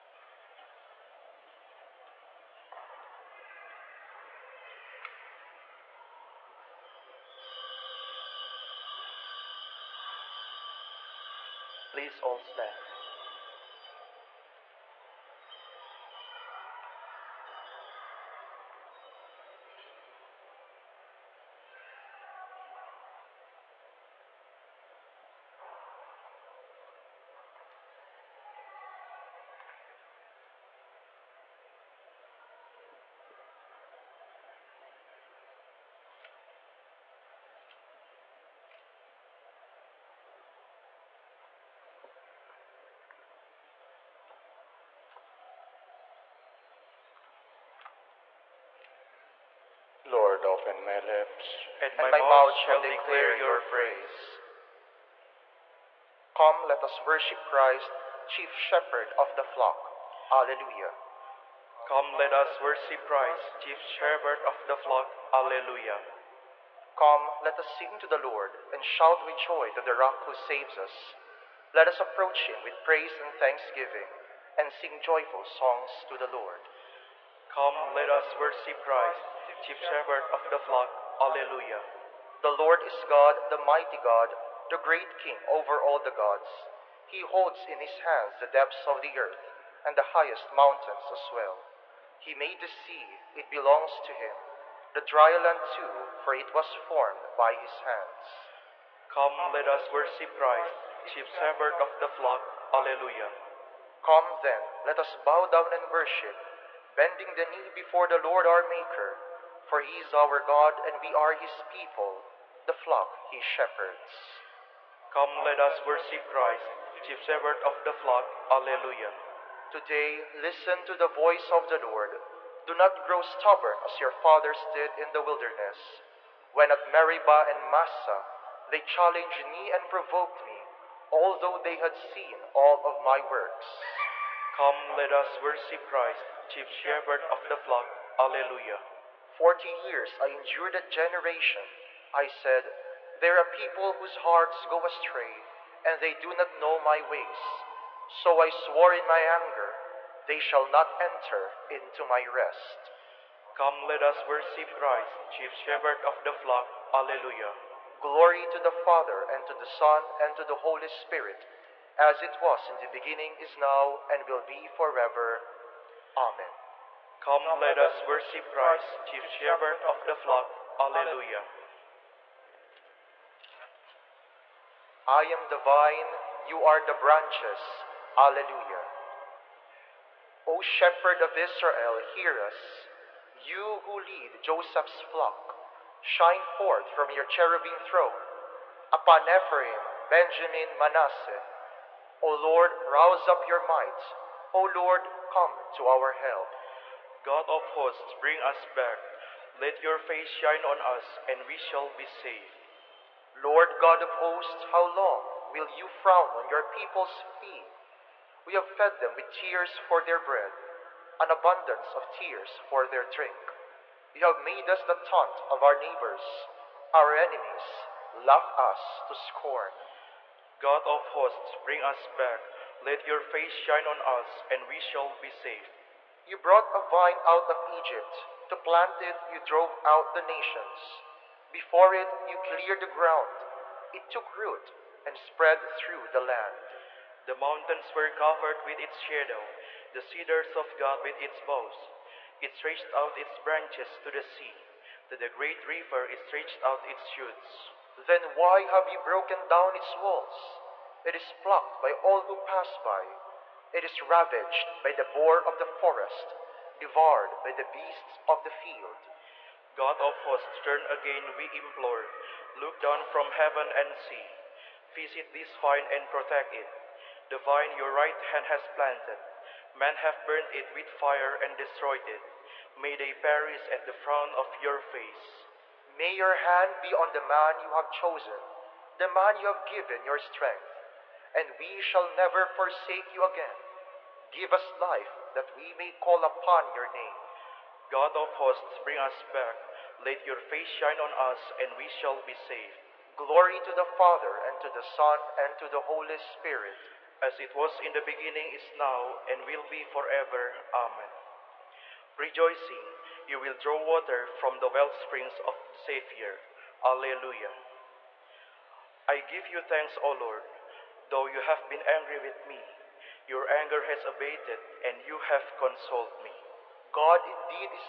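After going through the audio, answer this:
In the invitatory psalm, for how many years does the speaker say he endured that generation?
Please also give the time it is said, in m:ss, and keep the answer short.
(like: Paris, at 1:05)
40, at 2:19.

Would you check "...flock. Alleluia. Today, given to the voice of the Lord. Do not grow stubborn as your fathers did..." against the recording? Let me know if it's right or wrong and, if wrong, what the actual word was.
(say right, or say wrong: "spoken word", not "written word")
wrong: "listen", not "given".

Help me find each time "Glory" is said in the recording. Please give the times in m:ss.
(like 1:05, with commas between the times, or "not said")
2:38, 4:53.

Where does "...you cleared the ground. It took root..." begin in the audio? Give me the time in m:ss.
3:52.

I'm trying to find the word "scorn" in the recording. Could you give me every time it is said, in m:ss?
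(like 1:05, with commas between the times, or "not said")
3:39.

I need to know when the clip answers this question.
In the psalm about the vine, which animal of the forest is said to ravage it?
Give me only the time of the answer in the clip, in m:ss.
4:15.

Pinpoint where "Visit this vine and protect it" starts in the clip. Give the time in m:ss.
4:24.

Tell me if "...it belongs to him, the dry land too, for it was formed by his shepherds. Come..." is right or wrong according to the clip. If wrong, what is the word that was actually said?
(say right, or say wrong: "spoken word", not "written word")
wrong: "hands", not "shepherds".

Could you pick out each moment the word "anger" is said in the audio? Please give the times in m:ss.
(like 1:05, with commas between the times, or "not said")
2:29, 5:13.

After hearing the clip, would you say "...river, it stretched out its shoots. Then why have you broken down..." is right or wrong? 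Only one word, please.
right.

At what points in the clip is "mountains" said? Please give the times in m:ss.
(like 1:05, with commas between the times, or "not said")
1:30, 3:57.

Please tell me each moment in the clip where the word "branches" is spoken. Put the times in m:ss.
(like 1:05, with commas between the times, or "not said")
2:56, 4:03.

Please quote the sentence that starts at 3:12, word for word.
O Lord, rouse up your might.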